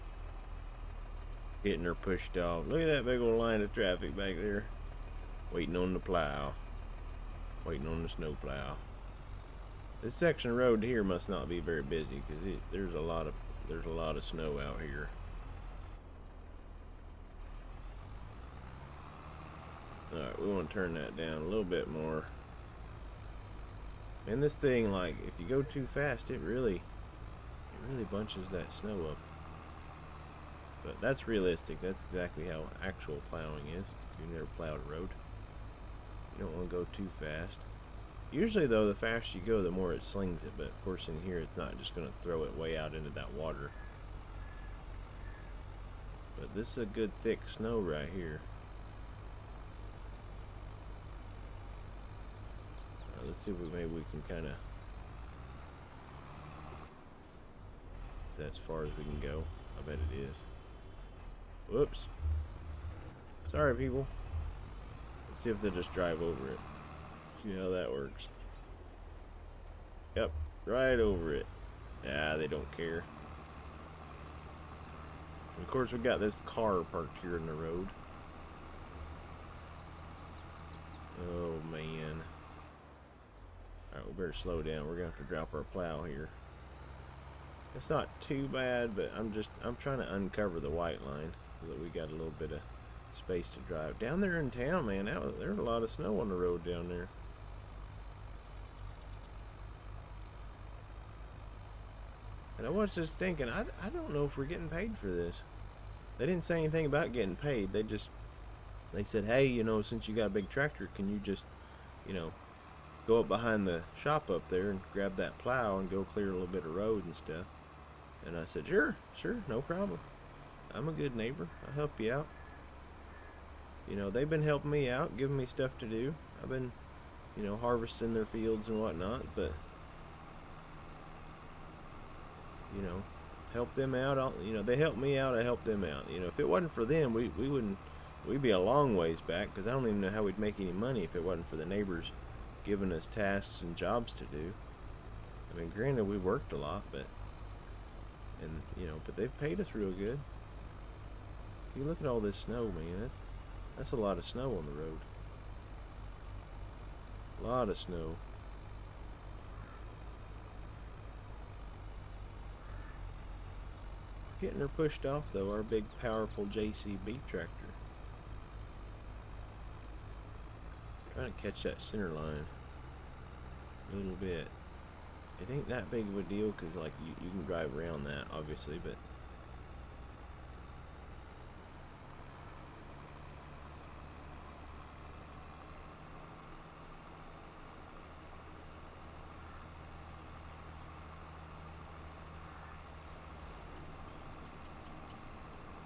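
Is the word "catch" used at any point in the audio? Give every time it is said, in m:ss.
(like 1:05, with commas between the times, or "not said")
2:51.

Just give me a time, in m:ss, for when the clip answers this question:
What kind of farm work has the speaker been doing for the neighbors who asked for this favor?
2:07.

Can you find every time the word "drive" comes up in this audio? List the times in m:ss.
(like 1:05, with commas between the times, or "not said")
1:05, 1:33, 2:57.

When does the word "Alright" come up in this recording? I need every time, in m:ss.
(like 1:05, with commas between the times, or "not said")
0:20, 1:23.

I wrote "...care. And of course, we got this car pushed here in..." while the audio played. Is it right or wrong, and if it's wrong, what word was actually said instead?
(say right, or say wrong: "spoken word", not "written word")
wrong: "parked", not "pushed".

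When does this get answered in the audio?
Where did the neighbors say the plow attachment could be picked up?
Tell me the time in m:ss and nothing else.
1:53.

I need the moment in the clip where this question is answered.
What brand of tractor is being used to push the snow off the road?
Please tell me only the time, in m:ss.
2:46.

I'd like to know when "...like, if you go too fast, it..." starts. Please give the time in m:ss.
0:24.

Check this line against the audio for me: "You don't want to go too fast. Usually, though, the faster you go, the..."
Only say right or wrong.
right.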